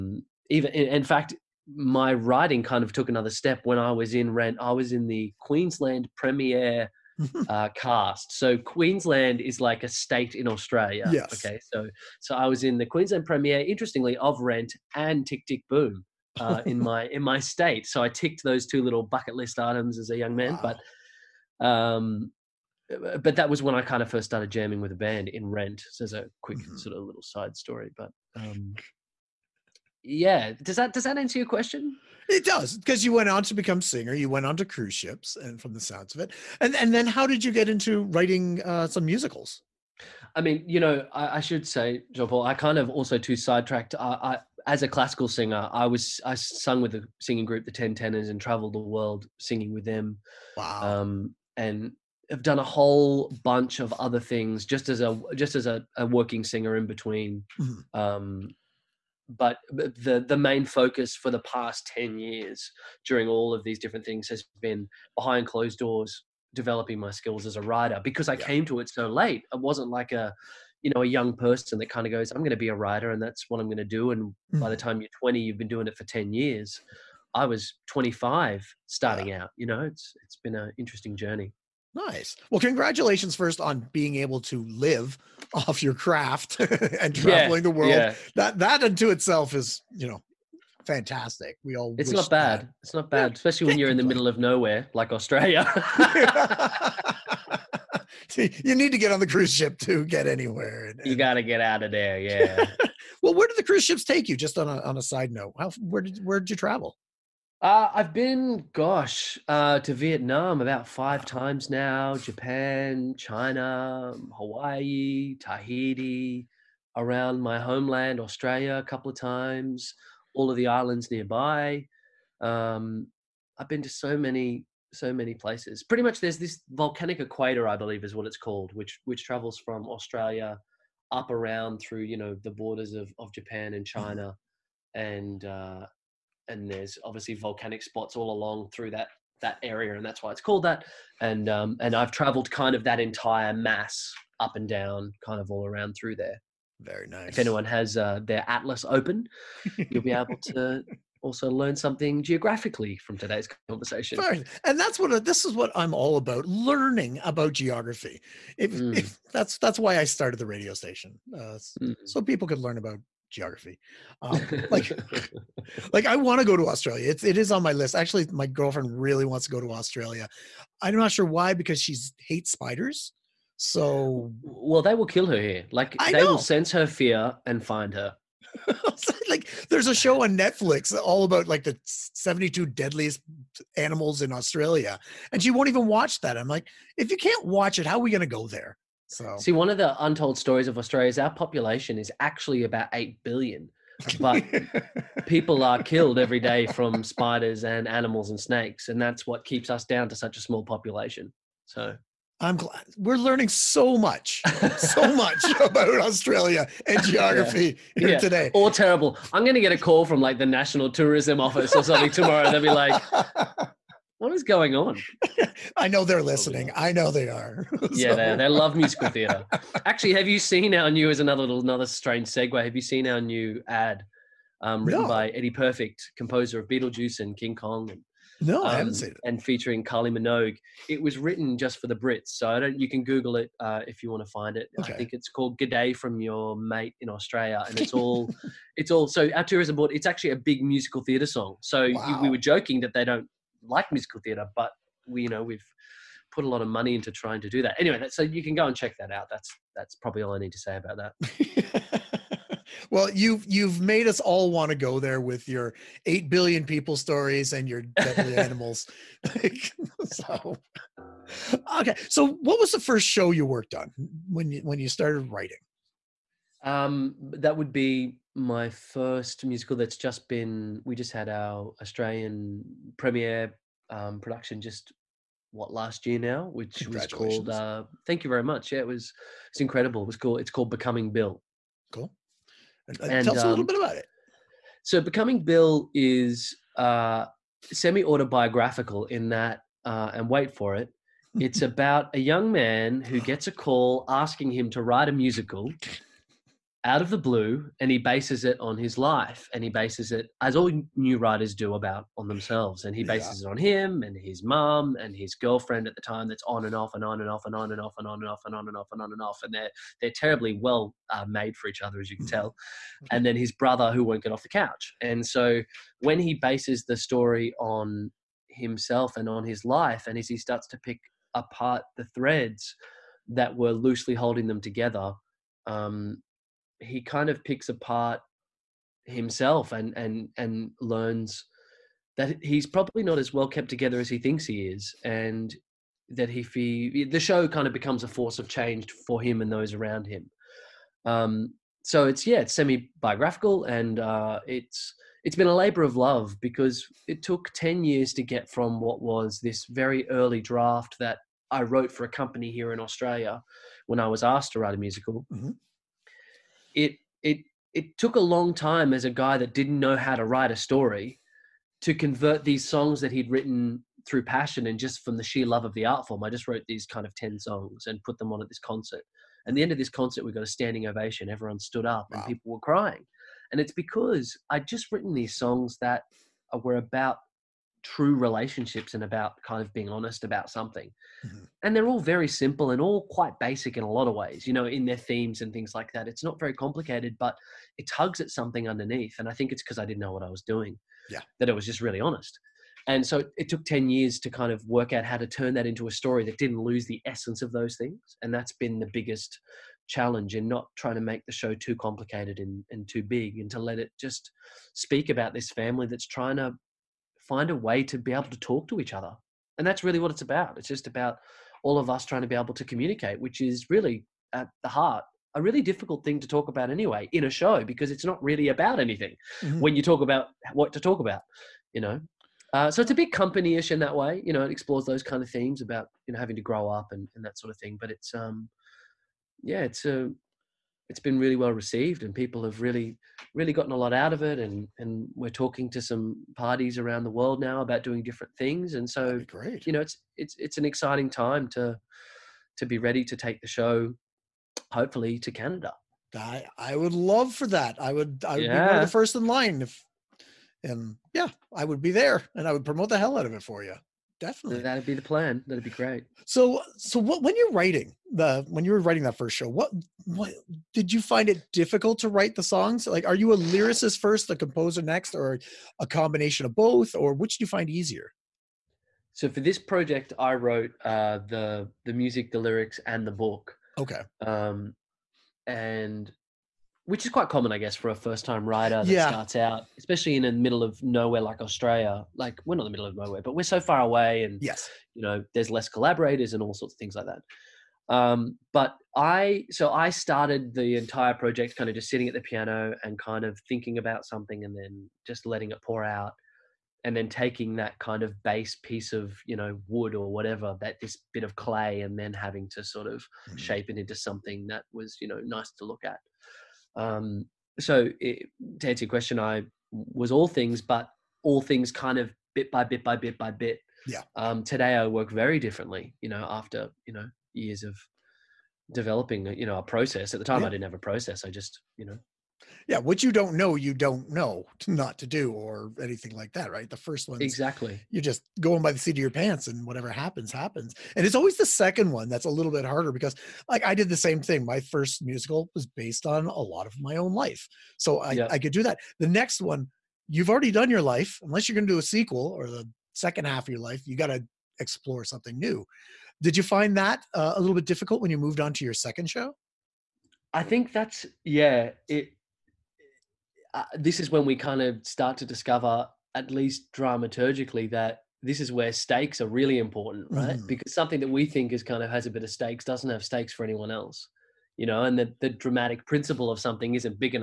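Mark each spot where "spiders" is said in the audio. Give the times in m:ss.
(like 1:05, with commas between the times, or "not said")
2:52, 3:17.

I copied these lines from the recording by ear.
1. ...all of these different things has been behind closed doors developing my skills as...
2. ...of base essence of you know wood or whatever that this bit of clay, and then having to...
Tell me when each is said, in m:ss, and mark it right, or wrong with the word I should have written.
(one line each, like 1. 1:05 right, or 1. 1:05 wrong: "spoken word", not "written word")
1. 1:03 right
2. 8:18 wrong: "piece", not "essence".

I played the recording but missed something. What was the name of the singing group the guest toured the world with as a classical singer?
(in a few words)
The 10 Tenors.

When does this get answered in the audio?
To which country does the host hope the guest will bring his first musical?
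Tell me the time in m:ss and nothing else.
7:25.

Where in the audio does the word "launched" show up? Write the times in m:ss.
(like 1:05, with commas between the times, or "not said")
not said.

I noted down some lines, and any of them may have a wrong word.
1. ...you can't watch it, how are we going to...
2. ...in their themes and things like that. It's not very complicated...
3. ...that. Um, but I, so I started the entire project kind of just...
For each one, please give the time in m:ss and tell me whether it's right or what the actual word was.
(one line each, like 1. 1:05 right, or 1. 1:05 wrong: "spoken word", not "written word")
1. 3:07 right
2. 6:24 right
3. 8:07 right.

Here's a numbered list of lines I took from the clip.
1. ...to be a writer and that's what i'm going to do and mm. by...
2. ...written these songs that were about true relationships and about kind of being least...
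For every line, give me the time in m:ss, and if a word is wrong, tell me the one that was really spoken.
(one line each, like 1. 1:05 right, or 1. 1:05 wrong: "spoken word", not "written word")
1. 1:12 right
2. 6:14 wrong: "honest", not "least".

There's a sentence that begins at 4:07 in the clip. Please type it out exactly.
Anyway, that, so you can go and check that out.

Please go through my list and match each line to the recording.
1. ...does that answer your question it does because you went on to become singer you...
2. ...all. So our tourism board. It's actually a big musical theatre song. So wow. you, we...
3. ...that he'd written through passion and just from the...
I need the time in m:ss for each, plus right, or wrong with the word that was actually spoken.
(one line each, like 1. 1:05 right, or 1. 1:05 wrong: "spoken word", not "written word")
1. 0:30 right
2. 3:58 right
3. 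6:03 right.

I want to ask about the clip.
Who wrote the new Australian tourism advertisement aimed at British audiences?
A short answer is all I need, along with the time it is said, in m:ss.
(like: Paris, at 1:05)
Eddie Perfect, at 3:45.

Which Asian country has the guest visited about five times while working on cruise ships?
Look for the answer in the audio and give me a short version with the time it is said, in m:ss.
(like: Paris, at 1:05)
Vietnam, at 1:49.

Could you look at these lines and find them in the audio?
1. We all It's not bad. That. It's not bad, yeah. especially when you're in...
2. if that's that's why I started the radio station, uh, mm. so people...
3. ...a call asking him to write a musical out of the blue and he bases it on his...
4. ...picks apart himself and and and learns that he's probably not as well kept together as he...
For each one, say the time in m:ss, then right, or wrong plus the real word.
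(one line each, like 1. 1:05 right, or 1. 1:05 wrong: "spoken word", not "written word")
1. 1:31 right
2. 2:38 right
3. 4:53 right
4. 5:27 right.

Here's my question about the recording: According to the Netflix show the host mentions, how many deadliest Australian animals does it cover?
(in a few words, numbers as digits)
72.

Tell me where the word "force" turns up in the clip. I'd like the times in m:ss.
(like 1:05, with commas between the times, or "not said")
5:38.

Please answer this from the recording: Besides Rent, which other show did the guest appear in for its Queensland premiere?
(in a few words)
Tick Tick Boom.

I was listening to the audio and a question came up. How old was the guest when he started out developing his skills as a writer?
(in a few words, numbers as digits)
25.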